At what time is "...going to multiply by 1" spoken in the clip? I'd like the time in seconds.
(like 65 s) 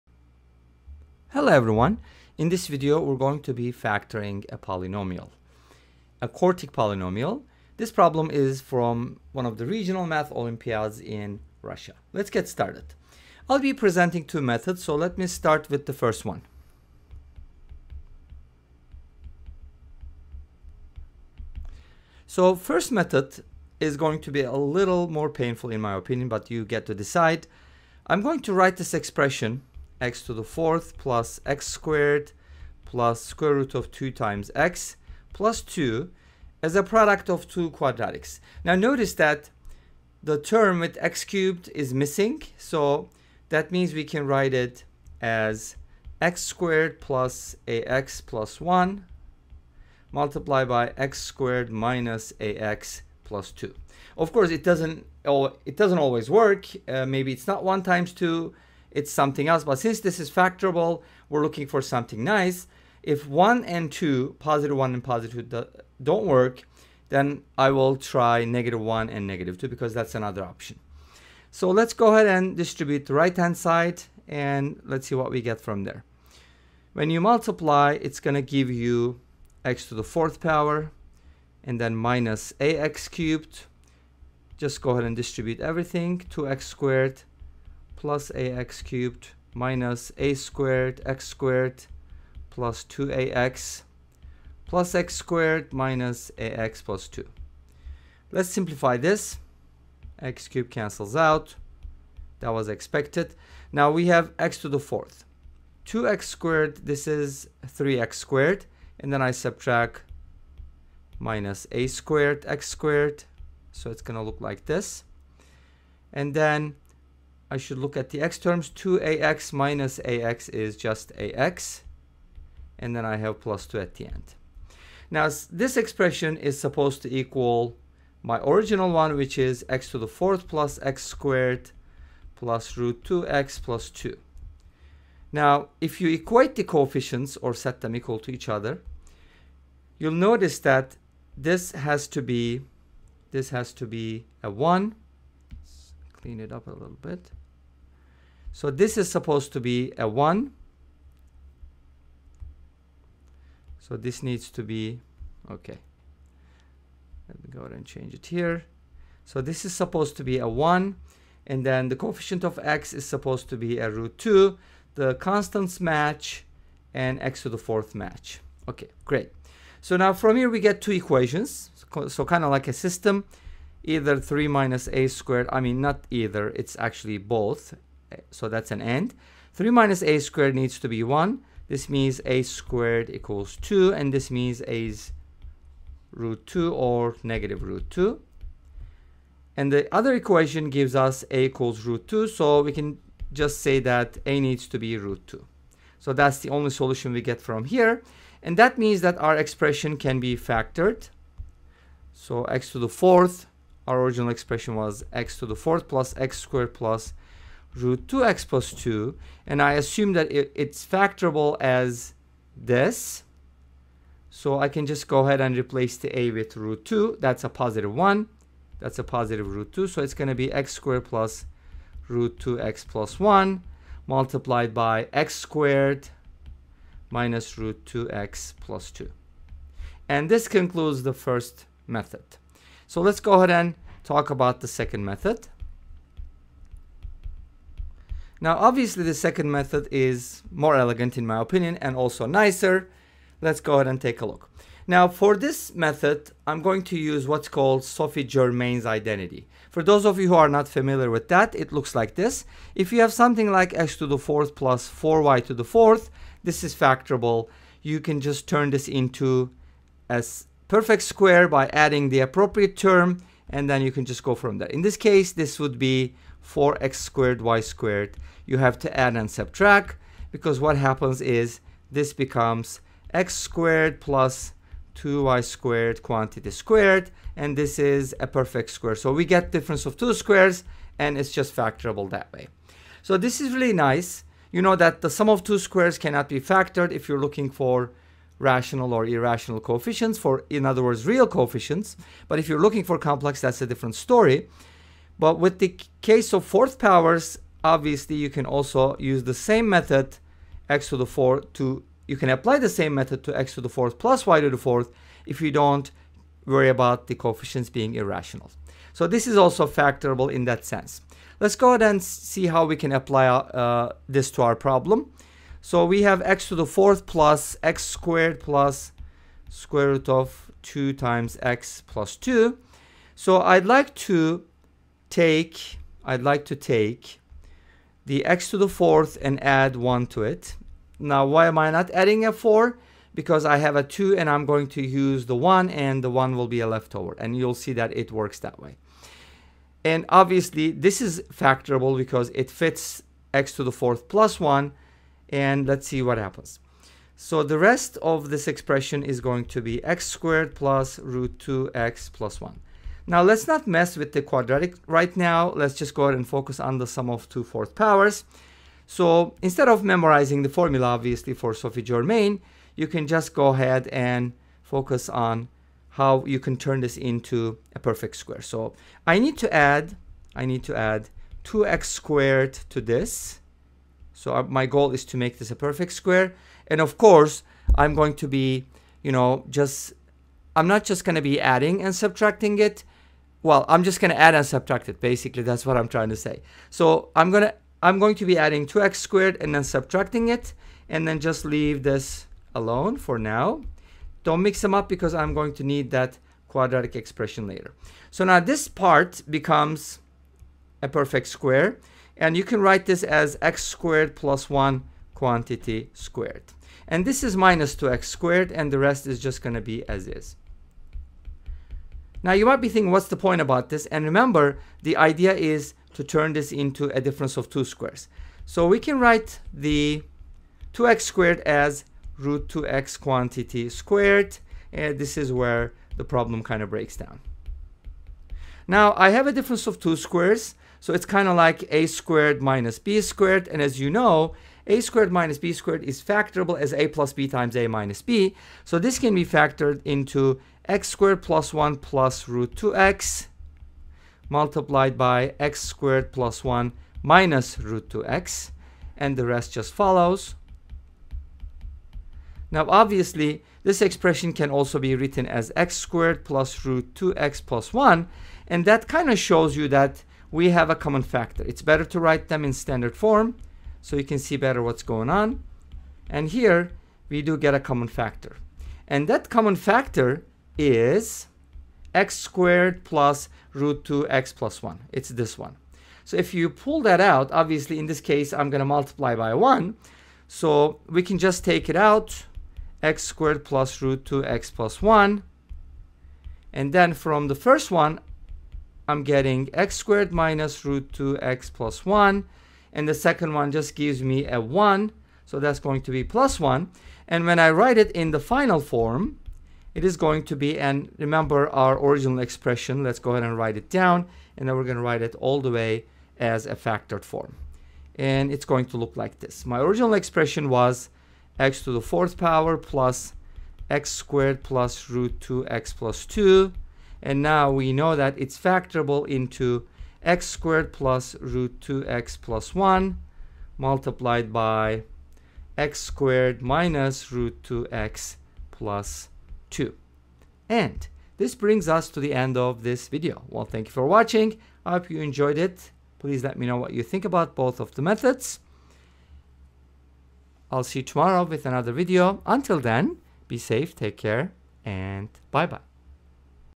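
478 s.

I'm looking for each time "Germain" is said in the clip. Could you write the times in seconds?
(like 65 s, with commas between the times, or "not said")
248 s, 361 s.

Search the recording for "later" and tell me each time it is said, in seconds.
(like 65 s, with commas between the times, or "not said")
397 s.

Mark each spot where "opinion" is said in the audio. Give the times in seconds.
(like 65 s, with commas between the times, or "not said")
25 s, 241 s.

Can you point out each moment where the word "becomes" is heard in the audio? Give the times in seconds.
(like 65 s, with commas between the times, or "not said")
272 s, 399 s.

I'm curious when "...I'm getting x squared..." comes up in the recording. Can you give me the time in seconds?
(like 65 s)
488 s.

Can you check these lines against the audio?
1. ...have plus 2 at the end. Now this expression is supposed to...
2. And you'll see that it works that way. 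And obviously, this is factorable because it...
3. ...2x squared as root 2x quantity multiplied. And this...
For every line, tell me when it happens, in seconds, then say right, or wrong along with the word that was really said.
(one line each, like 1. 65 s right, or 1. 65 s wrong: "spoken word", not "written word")
1. 123 s right
2. 337 s right
3. 420 s wrong: "squared", not "multiplied".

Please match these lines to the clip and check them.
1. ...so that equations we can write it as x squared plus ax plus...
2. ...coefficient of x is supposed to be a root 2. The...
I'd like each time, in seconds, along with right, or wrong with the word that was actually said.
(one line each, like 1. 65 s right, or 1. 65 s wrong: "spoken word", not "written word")
1. 42 s wrong: "means", not "equations"
2. 161 s right.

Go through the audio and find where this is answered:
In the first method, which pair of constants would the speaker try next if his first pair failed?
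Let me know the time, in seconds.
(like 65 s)
68 s.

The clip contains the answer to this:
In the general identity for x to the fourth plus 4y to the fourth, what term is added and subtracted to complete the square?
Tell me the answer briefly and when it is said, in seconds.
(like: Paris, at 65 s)
4x squared y squared, at 266 s.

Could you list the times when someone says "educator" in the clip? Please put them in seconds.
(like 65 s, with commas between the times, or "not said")
not said.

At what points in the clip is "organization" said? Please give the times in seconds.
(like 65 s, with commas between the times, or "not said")
not said.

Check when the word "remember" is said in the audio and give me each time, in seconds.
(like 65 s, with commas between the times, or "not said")
414 s, 500 s.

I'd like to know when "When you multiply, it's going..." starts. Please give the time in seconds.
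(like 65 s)
76 s.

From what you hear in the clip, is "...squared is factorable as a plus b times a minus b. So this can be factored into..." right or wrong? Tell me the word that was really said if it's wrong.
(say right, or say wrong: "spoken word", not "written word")
right.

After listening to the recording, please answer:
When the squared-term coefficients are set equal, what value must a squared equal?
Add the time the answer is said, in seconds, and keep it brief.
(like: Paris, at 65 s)
2, at 182 s.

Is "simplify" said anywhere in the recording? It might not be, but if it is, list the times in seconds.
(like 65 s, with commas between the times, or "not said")
98 s.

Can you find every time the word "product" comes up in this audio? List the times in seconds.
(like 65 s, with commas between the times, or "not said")
36 s.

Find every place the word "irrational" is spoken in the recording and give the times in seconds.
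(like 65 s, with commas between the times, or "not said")
289 s, 307 s.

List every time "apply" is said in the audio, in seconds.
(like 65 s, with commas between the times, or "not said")
302 s, 312 s.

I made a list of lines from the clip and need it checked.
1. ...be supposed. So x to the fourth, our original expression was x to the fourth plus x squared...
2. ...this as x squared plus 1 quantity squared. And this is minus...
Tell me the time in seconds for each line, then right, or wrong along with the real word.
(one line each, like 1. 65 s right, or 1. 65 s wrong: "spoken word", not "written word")
1. 200 s wrong: "factored", not "supposed"
2. 402 s right.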